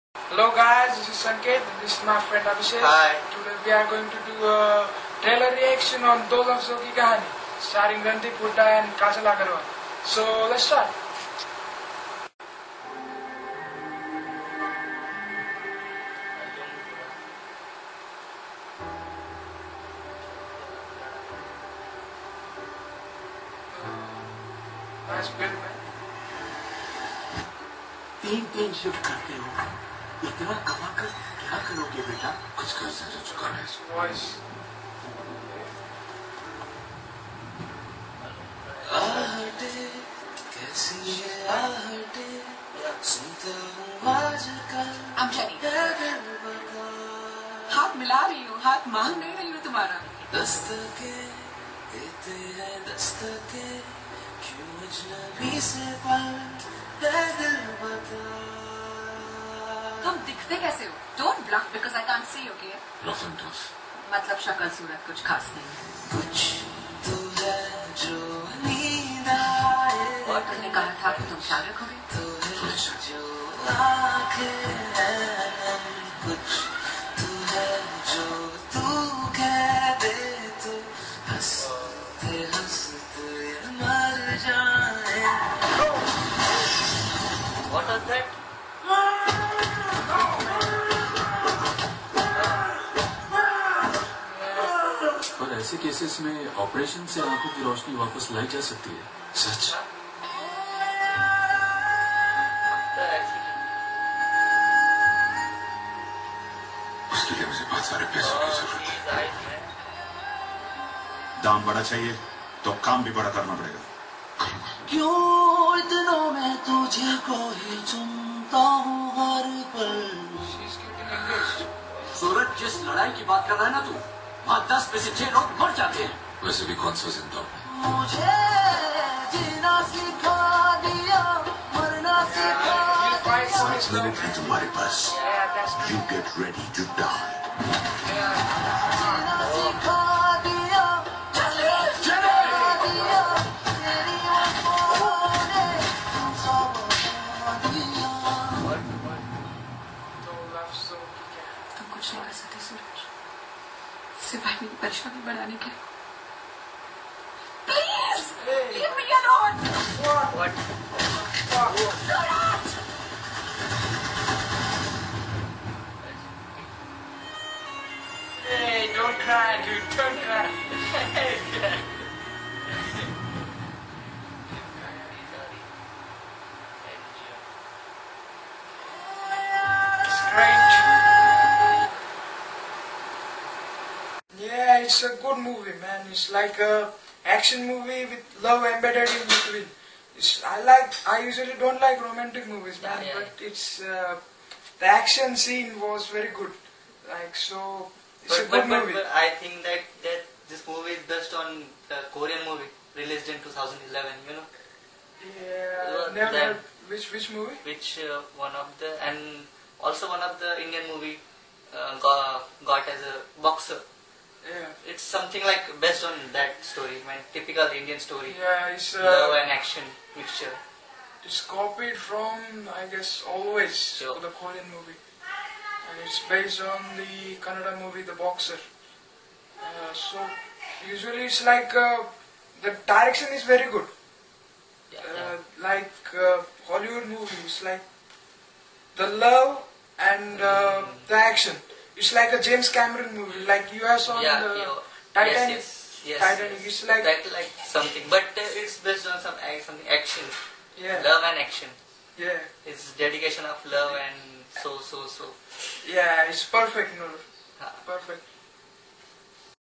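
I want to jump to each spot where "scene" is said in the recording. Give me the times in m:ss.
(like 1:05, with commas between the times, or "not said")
3:15.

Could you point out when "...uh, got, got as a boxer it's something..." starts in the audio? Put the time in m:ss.
3:31.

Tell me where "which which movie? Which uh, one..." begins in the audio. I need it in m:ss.
3:26.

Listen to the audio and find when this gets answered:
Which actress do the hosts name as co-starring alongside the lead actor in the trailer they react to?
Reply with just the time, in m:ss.
0:08.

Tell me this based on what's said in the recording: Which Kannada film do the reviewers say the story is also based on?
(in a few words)
The Boxer.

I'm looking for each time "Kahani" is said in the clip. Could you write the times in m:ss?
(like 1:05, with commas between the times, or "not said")
0:06.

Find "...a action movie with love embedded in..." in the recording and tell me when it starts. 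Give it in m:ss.
3:06.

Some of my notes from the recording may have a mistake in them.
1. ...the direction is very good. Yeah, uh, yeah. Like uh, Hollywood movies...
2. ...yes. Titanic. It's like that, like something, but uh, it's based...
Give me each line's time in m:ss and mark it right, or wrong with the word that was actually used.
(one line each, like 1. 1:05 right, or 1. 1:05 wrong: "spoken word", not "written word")
1. 3:52 right
2. 4:06 right.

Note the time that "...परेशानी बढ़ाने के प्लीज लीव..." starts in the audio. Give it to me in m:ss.
2:34.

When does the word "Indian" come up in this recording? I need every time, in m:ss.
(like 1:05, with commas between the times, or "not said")
3:30, 3:37.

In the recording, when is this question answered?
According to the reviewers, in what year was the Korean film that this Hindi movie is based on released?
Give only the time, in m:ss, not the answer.
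3:23.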